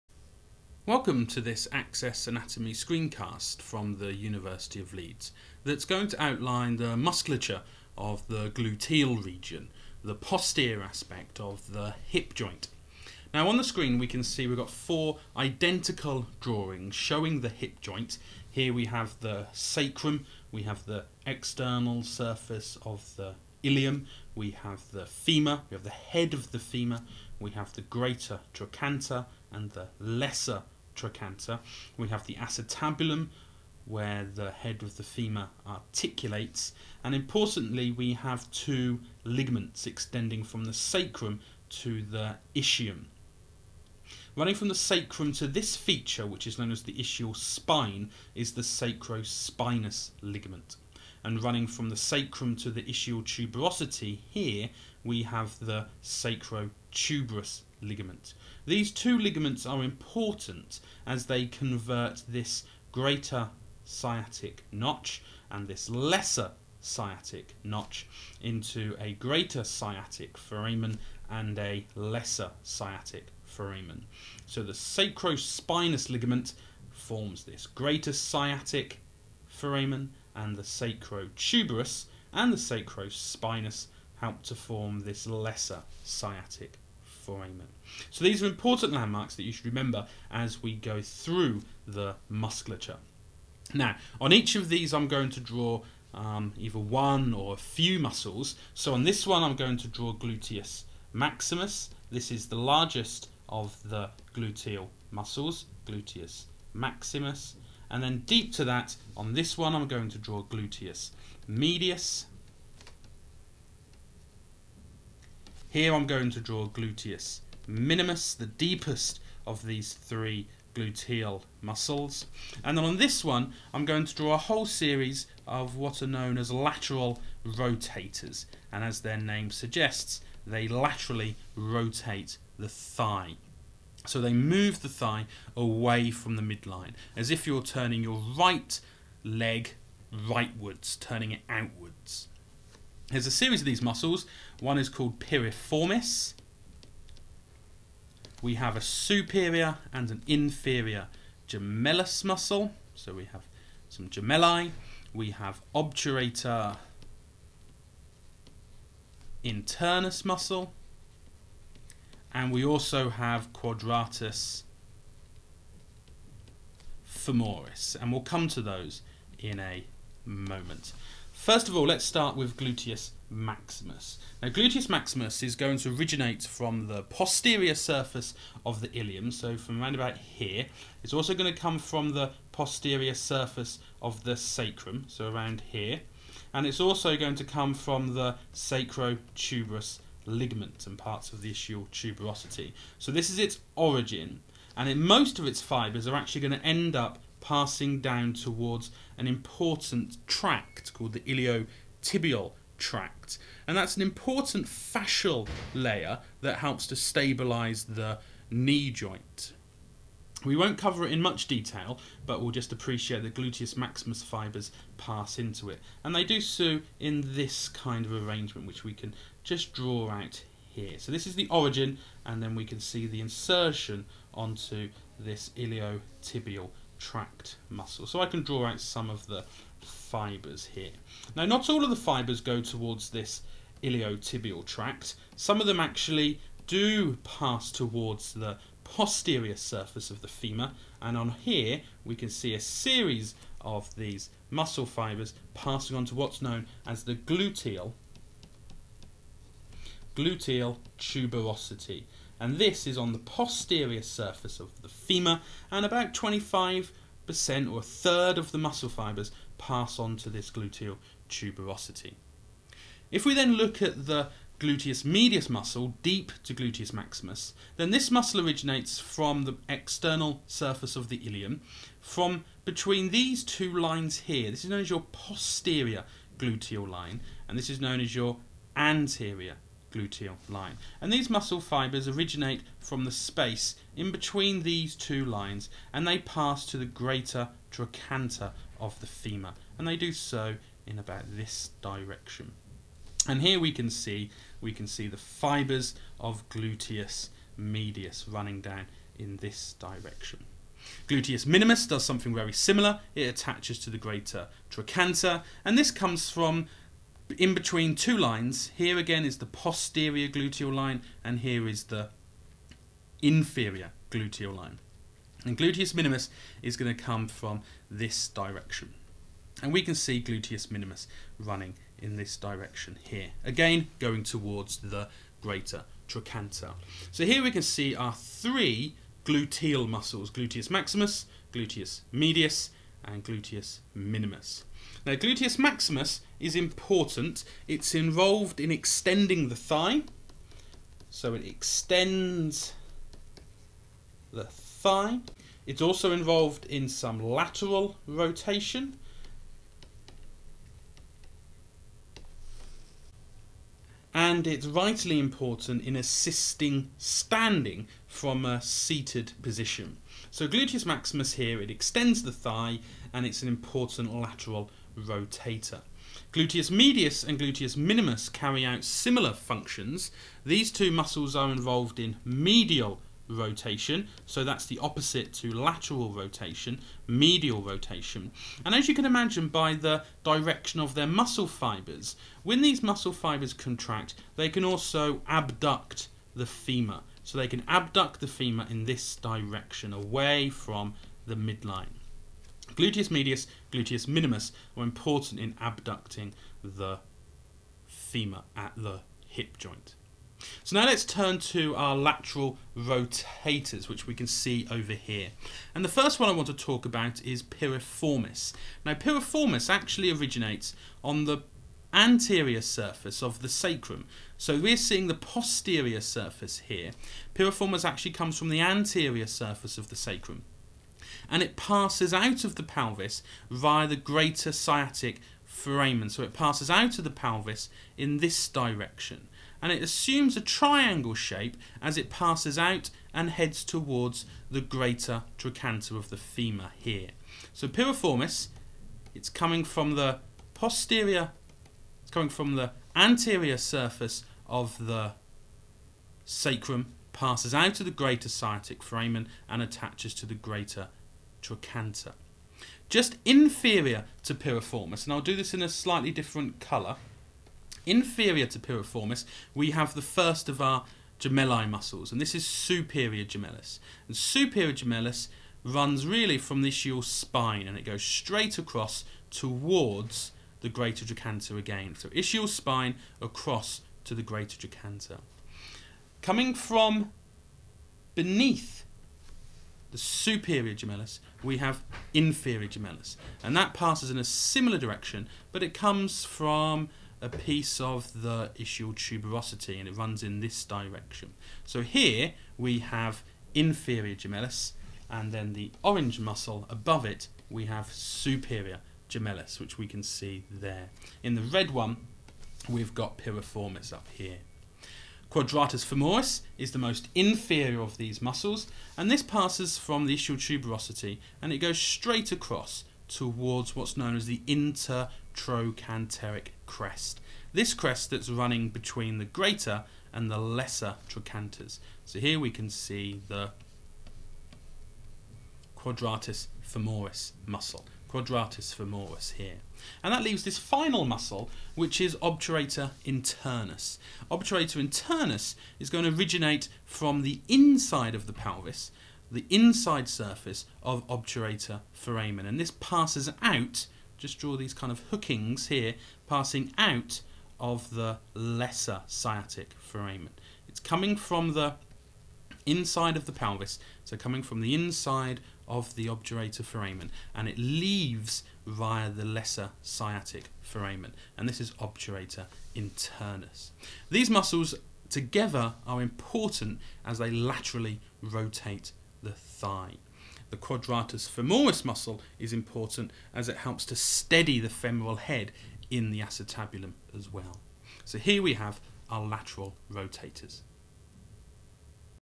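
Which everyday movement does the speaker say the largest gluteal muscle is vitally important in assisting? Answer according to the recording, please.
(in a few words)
Standing from a seated position.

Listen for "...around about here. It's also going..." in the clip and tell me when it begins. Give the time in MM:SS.
02:59.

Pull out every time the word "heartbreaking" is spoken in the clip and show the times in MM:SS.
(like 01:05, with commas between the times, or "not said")
not said.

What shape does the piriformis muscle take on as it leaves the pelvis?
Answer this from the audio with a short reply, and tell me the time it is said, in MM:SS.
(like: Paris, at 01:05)
Triangle, at 07:10.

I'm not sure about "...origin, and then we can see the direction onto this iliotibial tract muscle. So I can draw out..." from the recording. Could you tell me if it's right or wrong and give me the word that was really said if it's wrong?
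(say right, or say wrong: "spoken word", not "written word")
wrong: "insertion", not "direction".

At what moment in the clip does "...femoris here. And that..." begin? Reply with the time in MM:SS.
08:48.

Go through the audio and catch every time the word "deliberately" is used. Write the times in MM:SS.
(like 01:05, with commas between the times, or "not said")
not said.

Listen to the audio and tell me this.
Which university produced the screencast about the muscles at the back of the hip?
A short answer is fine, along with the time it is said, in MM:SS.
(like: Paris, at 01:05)
University of Leeds, at 00:04.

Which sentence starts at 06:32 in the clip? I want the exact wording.
Gluteus medius, gluteus minimus are important in abducting the femur at the hip joint.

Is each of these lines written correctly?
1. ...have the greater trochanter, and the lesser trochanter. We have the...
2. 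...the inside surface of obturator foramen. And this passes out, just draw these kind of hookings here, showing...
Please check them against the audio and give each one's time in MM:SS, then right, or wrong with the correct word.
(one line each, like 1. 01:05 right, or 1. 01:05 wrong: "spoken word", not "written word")
1. 00:27 right
2. 08:59 wrong: "passing", not "showing".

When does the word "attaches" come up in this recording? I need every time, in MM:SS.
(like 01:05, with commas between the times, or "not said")
05:03, 07:29.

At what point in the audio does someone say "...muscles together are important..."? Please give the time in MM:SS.
09:24.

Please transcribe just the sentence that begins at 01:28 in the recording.
So these are important landmarks that you should remember as we go through the musculature.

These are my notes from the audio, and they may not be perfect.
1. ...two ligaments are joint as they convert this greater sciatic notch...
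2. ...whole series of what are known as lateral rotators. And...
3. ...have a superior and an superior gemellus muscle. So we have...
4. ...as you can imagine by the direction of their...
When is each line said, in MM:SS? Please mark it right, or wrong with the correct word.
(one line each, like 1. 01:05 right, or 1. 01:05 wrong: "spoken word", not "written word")
1. 00:58 wrong: "important", not "joint"
2. 02:04 right
3. 02:28 wrong: "inferior", not "superior"
4. 06:18 right.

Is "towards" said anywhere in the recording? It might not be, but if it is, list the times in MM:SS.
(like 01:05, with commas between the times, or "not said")
03:18, 03:52, 03:57, 05:24, 07:13, 07:49, 08:33.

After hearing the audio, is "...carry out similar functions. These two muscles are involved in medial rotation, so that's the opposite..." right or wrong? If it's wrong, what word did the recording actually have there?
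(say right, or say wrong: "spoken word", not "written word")
right.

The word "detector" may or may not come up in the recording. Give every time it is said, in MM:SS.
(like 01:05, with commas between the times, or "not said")
not said.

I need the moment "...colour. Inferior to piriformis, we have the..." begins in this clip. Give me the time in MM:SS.
07:36.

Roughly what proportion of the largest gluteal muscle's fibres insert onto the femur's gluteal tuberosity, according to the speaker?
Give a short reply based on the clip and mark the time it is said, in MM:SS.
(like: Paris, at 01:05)
25%, at 04:16.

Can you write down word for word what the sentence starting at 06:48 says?
Now piriformis actually originates on the anterior surface of the sacrum.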